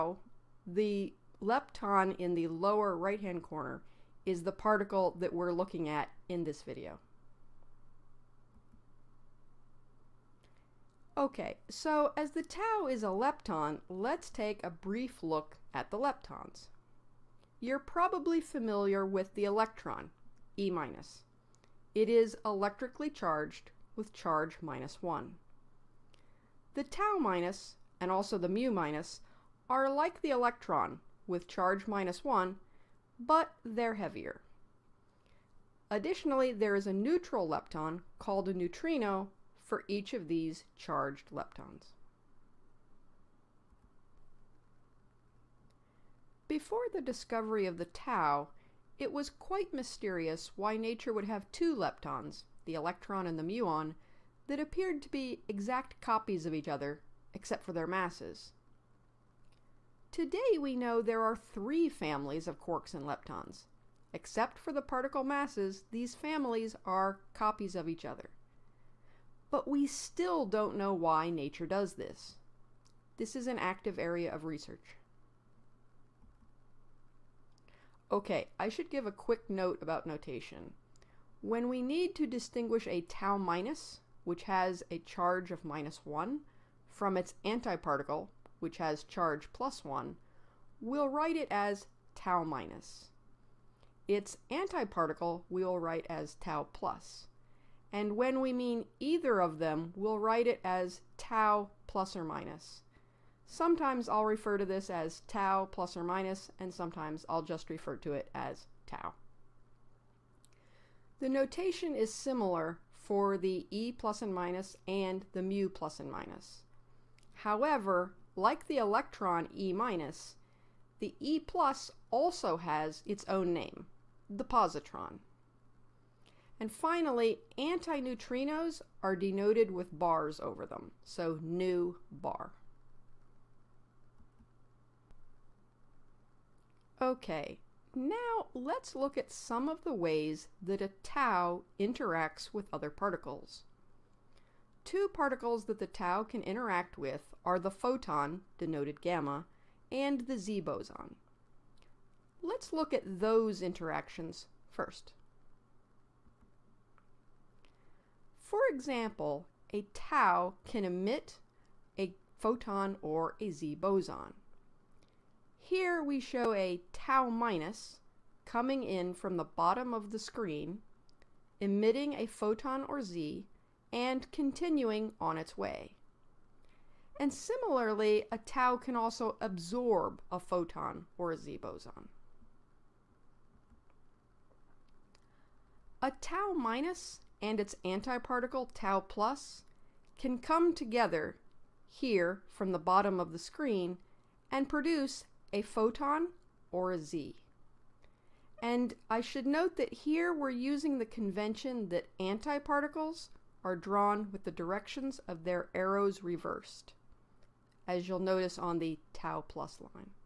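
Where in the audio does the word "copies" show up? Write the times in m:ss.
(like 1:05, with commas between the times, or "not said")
0:56, 1:07.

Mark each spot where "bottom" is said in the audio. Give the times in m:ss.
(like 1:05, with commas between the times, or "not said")
2:49, 3:12.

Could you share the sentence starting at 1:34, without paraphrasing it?
Its antiparticle we'll write as tau plus.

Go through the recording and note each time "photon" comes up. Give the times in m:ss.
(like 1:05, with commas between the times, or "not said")
2:27, 2:42, 2:52, 3:00, 3:15.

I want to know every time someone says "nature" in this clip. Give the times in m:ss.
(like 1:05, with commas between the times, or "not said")
0:50, 1:11.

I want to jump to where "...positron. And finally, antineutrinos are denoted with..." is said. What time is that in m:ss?
2:04.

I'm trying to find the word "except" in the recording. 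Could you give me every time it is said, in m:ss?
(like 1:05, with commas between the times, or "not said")
0:57, 1:04.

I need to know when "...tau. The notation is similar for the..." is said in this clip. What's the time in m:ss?
1:48.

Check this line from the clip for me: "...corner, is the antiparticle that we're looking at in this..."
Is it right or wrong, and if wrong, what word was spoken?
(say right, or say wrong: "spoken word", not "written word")
wrong: "particle", not "antiparticle".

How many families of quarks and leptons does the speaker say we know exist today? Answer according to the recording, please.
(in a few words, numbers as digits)
3.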